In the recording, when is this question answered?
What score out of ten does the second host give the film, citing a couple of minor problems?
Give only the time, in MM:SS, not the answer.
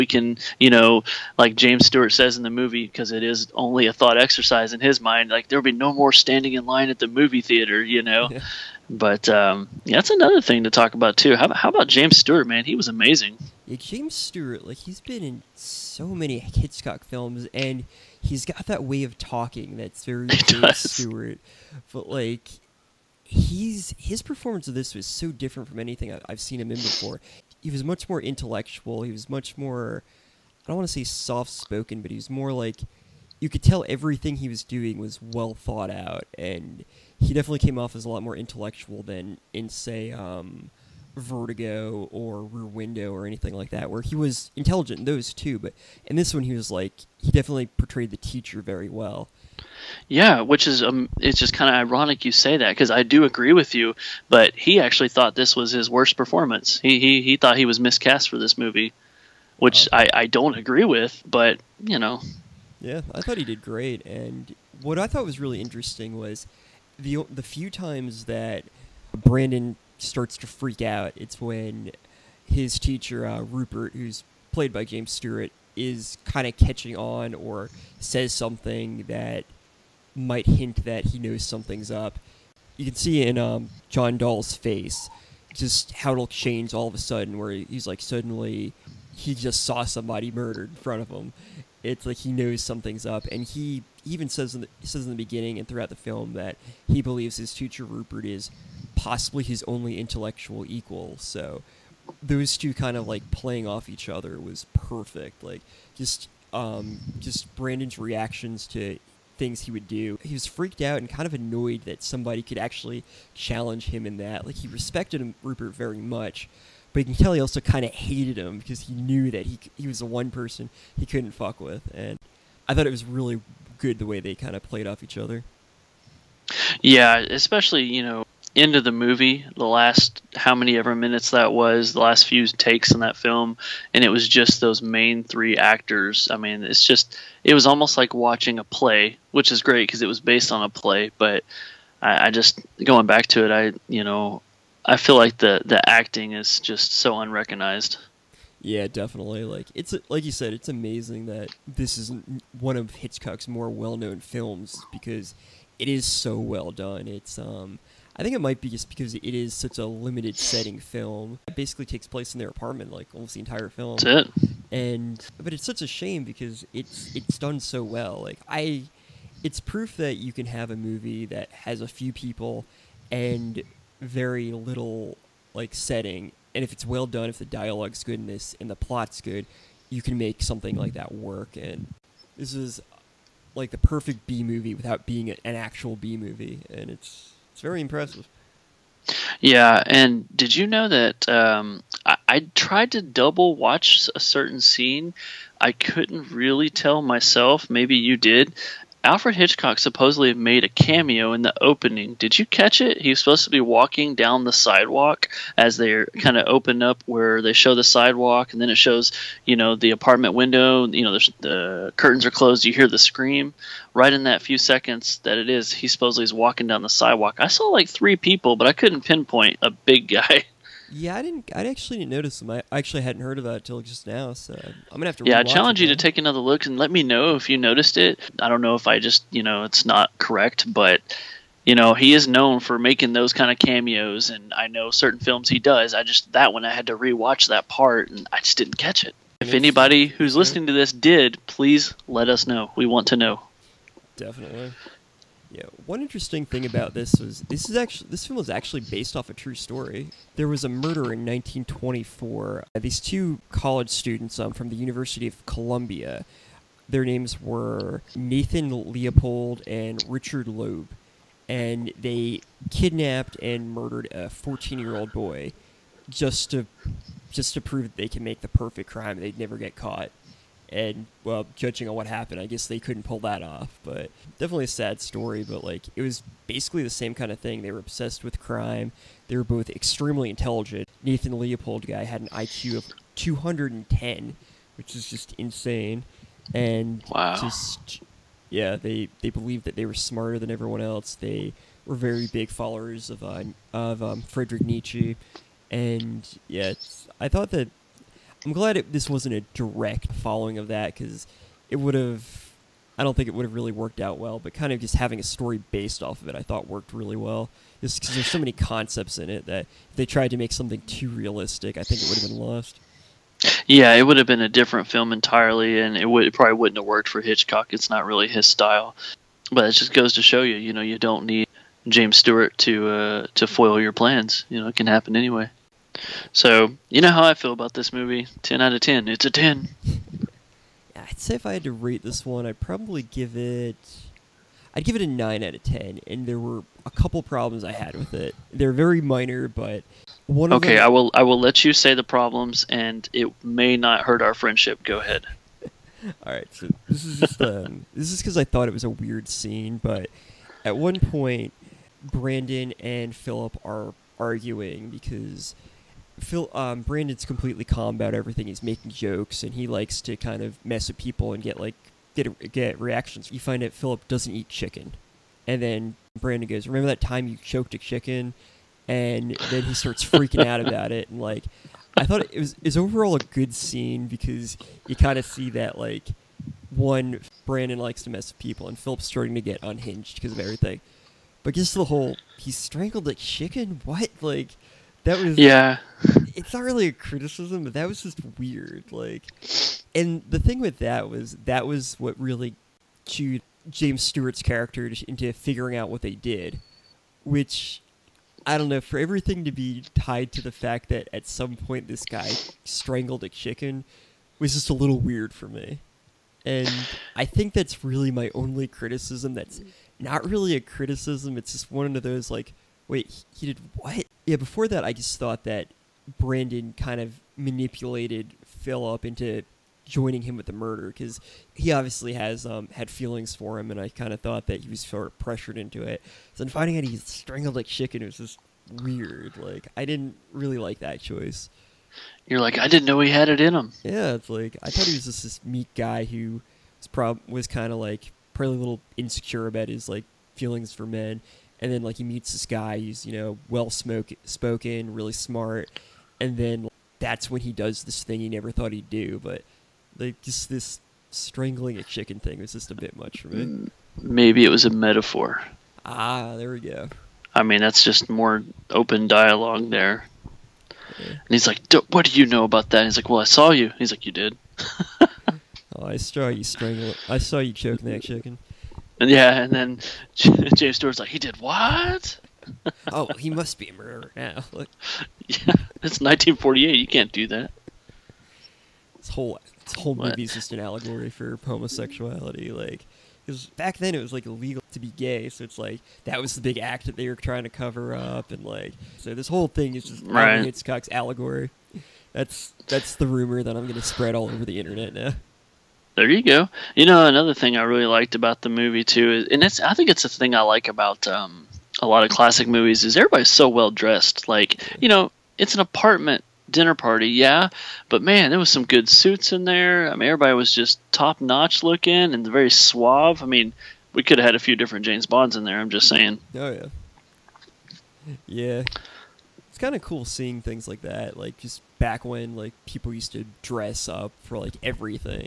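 05:35.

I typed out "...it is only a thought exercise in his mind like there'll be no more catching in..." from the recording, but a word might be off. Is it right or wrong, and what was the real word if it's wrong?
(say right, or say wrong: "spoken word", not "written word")
wrong: "standing", not "catching".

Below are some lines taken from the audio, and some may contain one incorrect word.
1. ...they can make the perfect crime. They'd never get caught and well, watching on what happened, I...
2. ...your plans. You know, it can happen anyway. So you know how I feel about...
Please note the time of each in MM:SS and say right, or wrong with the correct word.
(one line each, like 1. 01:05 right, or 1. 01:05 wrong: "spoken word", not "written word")
1. 04:27 wrong: "judging", not "watching"
2. 05:23 right.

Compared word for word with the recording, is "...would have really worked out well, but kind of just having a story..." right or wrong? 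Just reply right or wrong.
right.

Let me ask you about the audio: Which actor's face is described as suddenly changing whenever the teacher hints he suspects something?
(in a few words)
John Dall.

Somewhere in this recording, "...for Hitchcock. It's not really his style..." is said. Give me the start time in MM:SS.
05:17.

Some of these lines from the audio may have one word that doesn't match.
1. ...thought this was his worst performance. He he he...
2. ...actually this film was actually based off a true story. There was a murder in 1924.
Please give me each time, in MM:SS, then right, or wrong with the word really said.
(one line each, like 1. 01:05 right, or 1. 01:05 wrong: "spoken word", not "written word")
1. 00:55 right
2. 04:07 right.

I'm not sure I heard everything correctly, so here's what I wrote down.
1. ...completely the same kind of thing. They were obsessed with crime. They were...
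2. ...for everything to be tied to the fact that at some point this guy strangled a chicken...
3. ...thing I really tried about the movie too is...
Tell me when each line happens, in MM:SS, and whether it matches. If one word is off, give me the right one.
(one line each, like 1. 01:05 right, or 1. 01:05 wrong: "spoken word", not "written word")
1. 04:36 wrong: "basically", not "completely"
2. 06:38 right
3. 08:17 wrong: "liked", not "tried".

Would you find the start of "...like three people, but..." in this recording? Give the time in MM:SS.
03:37.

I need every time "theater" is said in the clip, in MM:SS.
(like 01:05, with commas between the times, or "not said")
00:07.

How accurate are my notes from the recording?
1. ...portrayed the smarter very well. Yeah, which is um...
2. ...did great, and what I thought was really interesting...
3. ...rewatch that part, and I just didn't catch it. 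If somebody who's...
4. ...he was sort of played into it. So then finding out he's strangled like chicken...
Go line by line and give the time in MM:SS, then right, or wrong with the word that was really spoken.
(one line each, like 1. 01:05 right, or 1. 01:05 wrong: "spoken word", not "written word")
1. 00:47 wrong: "teacher", not "smarter"
2. 01:03 right
3. 03:56 wrong: "anybody", not "somebody"
4. 07:04 wrong: "pressured", not "played".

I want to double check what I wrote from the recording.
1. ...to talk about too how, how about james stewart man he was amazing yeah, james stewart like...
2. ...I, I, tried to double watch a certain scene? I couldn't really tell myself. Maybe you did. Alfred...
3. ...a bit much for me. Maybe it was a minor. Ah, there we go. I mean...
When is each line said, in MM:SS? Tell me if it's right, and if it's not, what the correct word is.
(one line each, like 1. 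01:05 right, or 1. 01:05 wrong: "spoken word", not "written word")
1. 00:10 right
2. 03:12 right
3. 07:32 wrong: "metaphor", not "minor".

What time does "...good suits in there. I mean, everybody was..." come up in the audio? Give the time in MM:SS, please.
08:28.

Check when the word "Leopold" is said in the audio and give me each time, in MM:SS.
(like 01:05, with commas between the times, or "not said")
04:18, 04:41.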